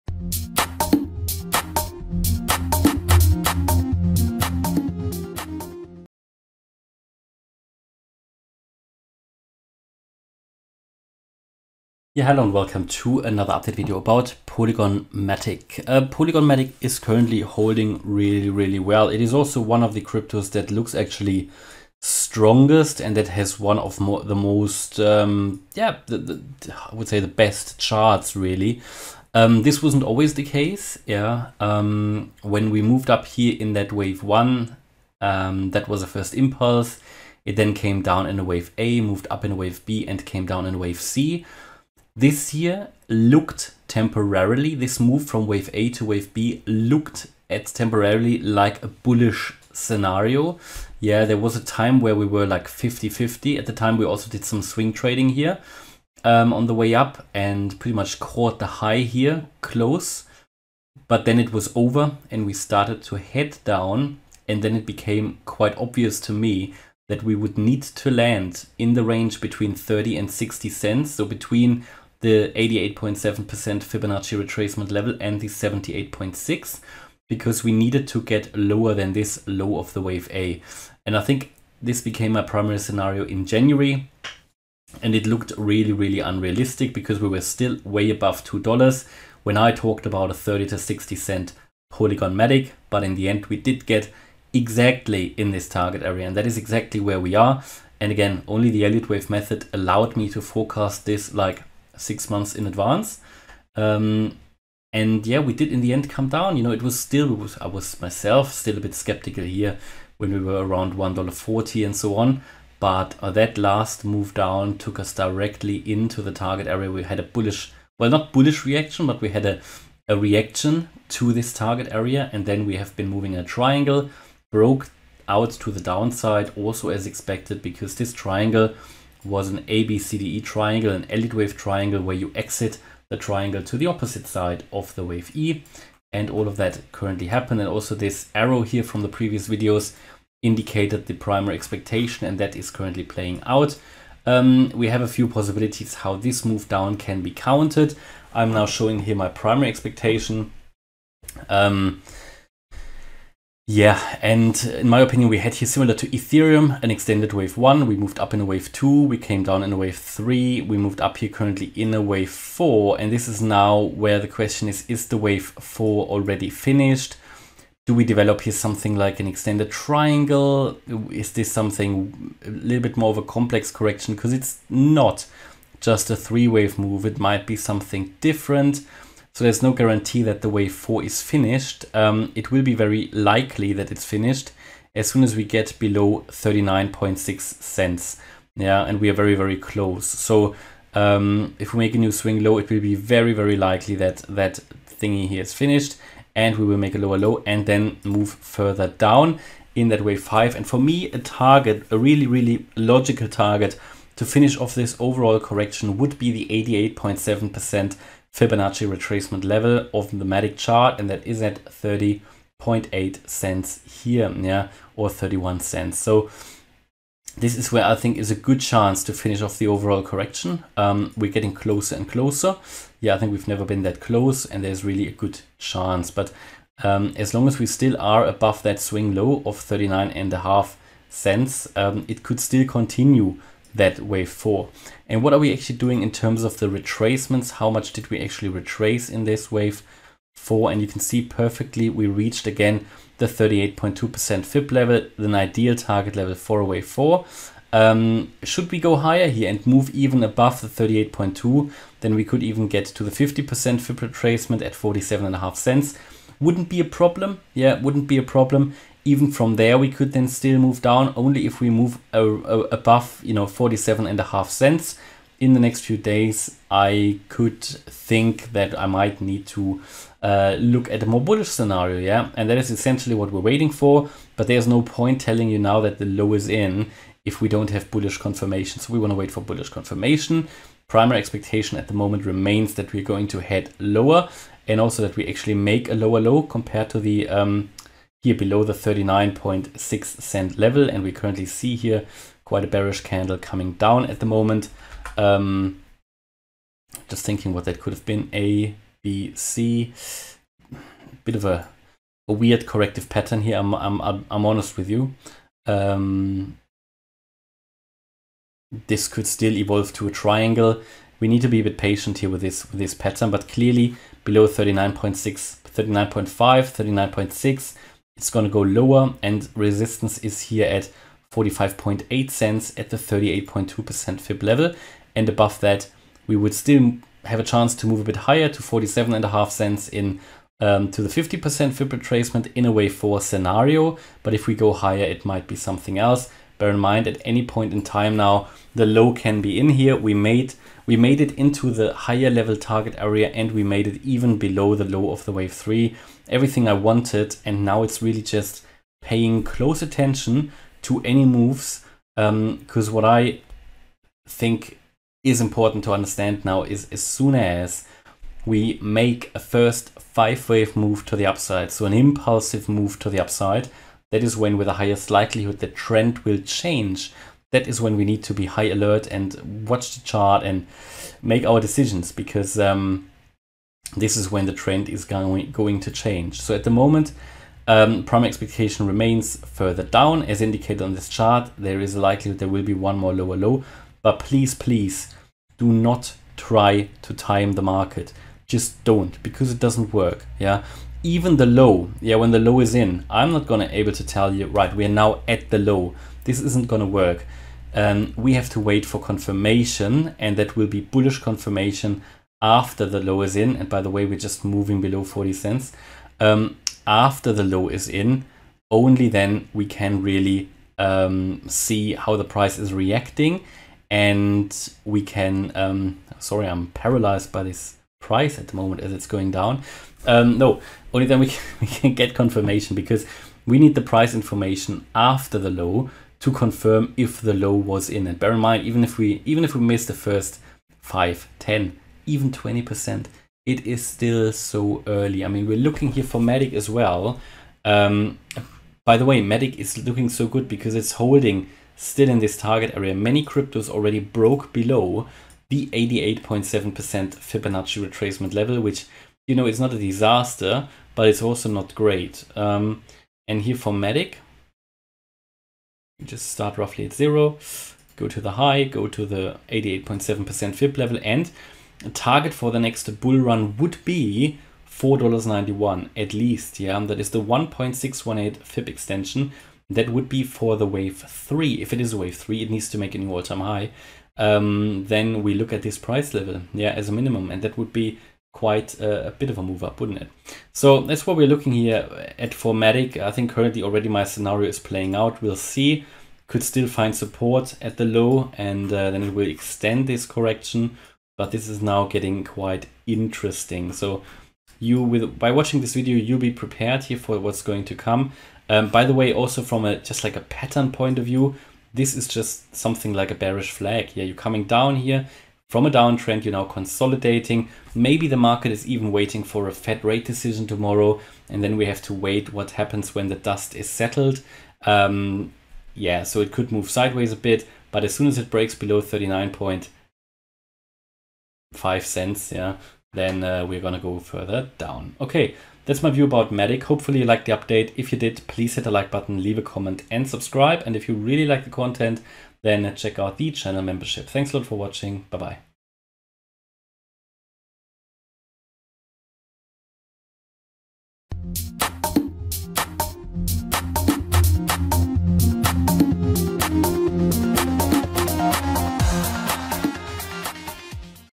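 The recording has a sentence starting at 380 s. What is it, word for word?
As indicated on this chart, there is a likelihood there will be one more lower low.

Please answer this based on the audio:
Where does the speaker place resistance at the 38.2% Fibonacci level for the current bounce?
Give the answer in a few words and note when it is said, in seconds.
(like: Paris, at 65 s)
45.8 cents, at 321 s.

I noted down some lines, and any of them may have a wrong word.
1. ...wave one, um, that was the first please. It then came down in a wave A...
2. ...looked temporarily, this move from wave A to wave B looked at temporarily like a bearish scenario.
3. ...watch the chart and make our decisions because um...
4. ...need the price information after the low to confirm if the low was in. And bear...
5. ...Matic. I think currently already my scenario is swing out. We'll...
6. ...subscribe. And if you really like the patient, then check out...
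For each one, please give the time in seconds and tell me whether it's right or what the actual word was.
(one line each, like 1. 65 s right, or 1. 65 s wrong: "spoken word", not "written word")
1. 33 s wrong: "impulse", not "please"
2. 43 s wrong: "bullish", not "bearish"
3. 369 s right
4. 423 s right
5. 482 s wrong: "playing", not "swing"
6. 530 s wrong: "content", not "patient".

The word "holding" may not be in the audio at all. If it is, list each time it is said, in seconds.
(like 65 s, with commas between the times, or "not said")
17 s, 440 s.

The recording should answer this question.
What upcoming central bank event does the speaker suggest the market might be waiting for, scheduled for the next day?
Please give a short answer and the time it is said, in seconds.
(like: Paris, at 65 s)
Fed rate decision, at 509 s.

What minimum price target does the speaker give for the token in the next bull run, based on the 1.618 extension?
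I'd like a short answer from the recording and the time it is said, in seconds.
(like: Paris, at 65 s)
$4.91, at 464 s.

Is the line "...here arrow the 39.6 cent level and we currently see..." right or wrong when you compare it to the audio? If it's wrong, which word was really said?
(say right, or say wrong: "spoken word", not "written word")
wrong: "below", not "arrow".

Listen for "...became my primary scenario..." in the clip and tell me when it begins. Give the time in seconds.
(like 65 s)
82 s.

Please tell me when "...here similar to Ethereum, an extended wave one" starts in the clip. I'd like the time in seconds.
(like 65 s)
155 s.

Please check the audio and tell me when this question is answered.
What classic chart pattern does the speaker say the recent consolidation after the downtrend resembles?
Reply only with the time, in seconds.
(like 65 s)
503 s.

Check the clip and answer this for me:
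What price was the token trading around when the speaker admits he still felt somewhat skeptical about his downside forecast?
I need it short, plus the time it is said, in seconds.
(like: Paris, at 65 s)
$1.40, at 110 s.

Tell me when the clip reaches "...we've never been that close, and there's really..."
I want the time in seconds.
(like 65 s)
223 s.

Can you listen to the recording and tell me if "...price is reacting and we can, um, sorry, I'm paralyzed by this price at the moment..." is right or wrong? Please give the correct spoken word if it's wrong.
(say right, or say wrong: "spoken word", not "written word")
right.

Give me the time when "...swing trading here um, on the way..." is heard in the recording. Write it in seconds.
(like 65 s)
54 s.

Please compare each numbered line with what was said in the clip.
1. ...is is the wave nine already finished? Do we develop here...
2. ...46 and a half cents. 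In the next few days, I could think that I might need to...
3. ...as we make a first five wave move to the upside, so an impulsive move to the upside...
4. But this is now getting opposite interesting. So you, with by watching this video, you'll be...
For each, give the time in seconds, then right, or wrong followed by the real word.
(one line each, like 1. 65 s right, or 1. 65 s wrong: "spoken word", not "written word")
1. 164 s wrong: "four", not "nine"
2. 263 s wrong: "47", not "46"
3. 357 s right
4. 491 s wrong: "quite", not "opposite".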